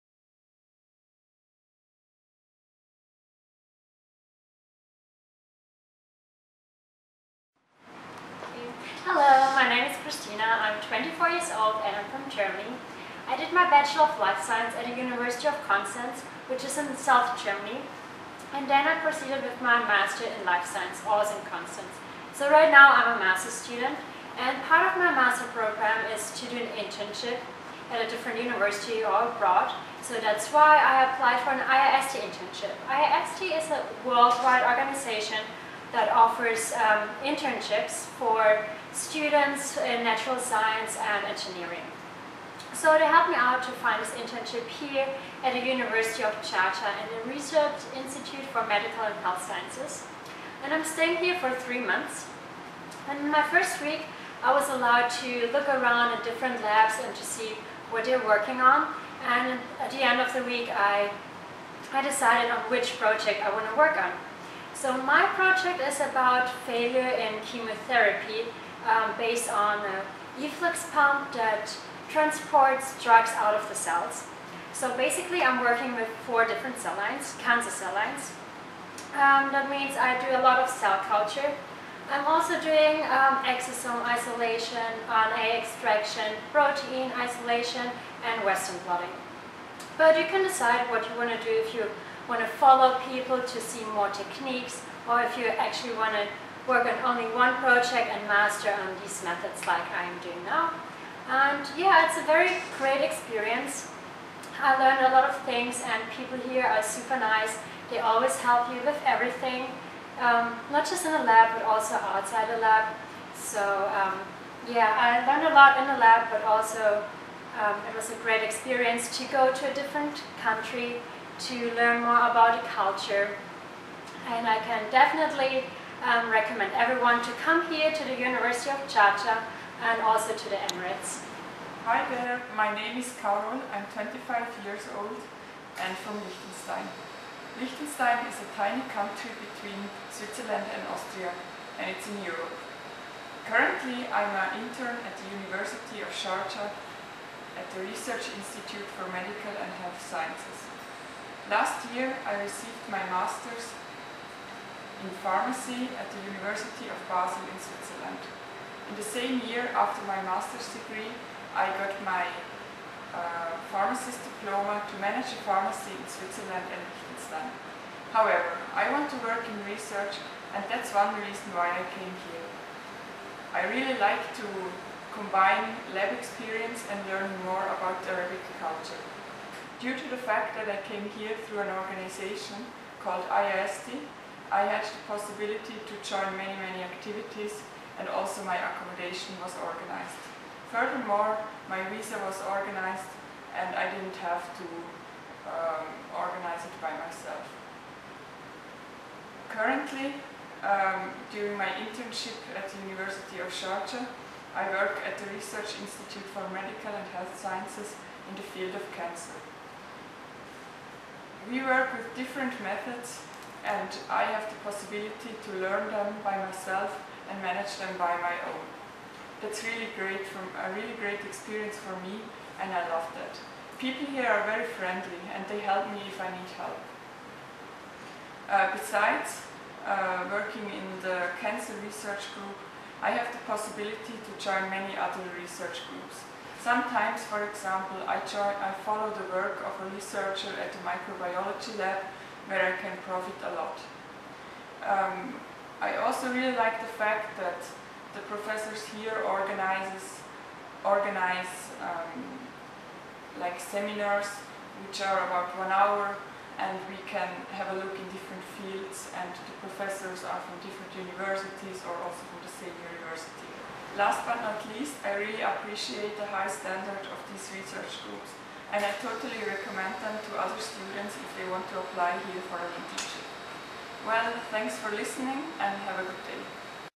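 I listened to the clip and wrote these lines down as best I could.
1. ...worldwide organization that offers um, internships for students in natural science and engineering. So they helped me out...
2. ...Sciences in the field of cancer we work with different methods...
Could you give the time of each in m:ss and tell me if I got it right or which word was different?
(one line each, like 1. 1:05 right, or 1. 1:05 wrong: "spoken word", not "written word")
1. 0:34 right
2. 3:27 right.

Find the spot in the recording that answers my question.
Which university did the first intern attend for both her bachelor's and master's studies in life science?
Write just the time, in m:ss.
0:14.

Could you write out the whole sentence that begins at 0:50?
And I'm staying here for three months.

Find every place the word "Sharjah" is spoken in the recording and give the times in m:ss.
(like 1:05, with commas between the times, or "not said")
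0:46, 2:08, 2:26, 3:23.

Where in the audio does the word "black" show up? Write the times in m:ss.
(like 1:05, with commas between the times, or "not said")
not said.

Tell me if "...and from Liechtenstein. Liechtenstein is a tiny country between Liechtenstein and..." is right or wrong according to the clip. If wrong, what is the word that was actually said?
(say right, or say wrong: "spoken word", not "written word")
wrong: "Switzerland", not "Liechtenstein".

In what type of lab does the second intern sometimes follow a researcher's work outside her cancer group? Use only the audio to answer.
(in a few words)
microbiology lab.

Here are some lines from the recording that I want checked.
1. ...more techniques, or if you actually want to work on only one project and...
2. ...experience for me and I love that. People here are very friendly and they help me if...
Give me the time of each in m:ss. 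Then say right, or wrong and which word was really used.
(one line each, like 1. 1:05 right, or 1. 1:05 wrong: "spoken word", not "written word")
1. 1:33 right
2. 3:41 right.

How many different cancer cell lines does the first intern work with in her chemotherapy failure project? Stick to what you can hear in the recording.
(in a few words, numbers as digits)
4.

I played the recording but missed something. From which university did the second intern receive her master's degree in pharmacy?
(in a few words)
University of Basel.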